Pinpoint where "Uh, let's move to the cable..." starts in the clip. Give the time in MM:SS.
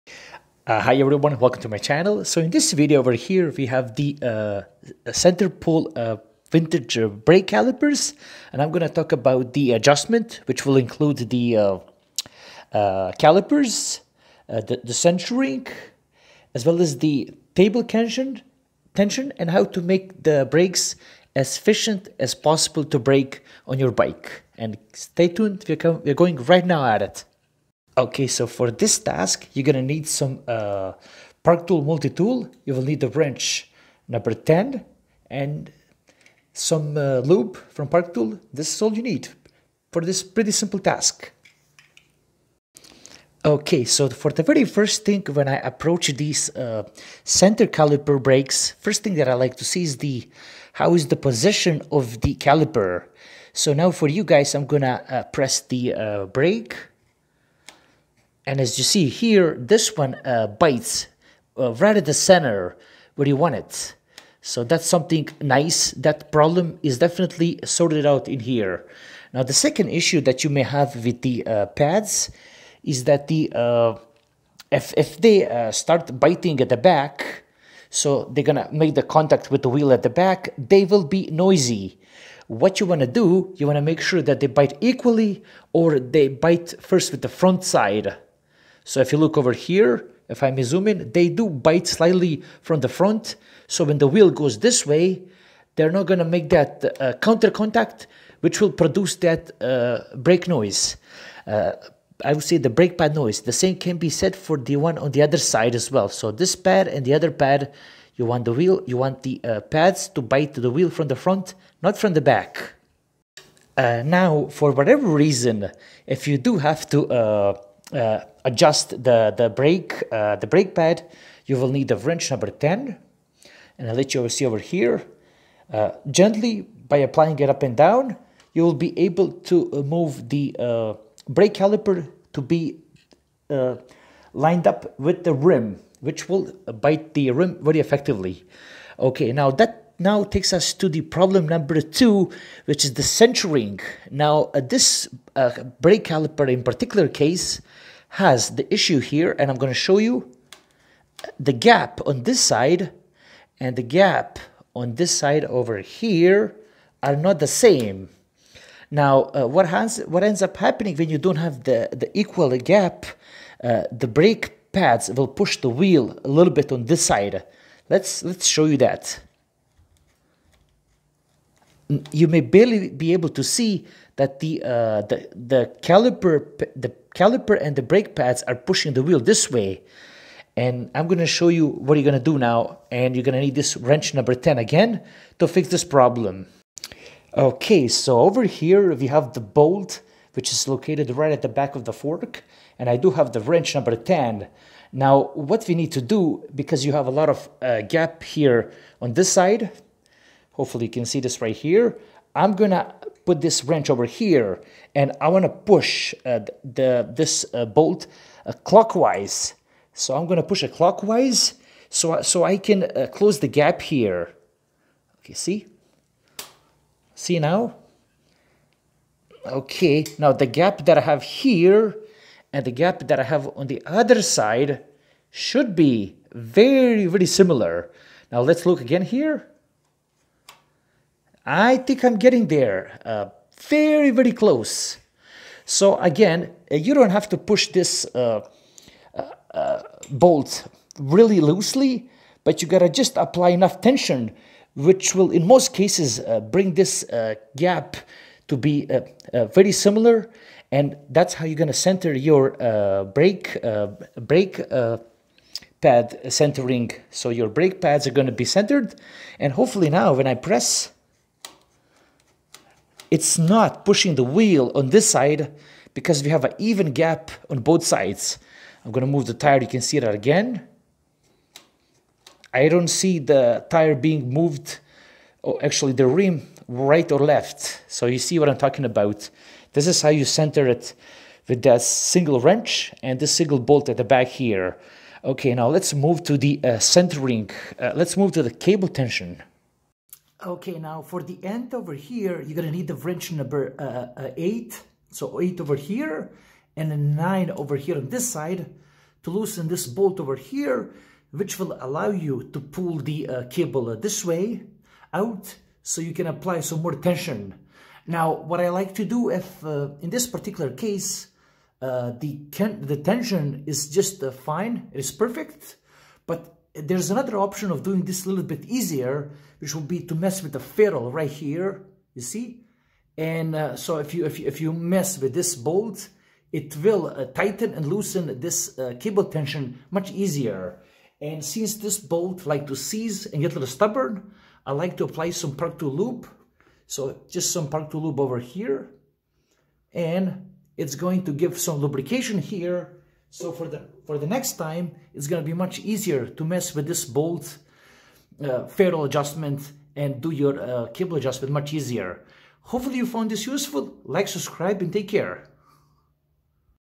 04:47.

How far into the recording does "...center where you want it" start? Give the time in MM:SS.
01:02.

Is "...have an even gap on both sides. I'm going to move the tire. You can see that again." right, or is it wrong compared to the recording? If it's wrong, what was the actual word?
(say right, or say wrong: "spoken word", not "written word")
right.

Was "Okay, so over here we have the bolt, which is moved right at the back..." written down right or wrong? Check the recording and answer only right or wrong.
wrong.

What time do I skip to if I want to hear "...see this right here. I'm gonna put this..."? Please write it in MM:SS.
03:21.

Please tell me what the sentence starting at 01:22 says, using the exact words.
What you wanna do, you wanna make sure that they bite equally or they bite first with the front side.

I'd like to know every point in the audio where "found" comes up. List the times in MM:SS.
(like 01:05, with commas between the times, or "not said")
05:53.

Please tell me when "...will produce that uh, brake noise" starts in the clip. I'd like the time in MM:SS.
01:38.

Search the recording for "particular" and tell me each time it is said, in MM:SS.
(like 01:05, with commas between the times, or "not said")
02:26, 05:10.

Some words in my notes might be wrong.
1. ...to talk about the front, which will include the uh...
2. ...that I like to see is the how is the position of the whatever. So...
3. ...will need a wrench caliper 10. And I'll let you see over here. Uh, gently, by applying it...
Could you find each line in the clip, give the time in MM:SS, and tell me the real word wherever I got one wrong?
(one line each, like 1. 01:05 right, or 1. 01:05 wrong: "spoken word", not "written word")
1. 00:08 wrong: "adjustment", not "front"
2. 00:49 wrong: "caliper", not "whatever"
3. 02:01 wrong: "number", not "caliper".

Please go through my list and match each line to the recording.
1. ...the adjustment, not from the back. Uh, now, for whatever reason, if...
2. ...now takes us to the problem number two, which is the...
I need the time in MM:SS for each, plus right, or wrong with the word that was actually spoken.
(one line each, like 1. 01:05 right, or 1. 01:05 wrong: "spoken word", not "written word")
1. 01:51 wrong: "front", not "adjustment"
2. 02:19 right.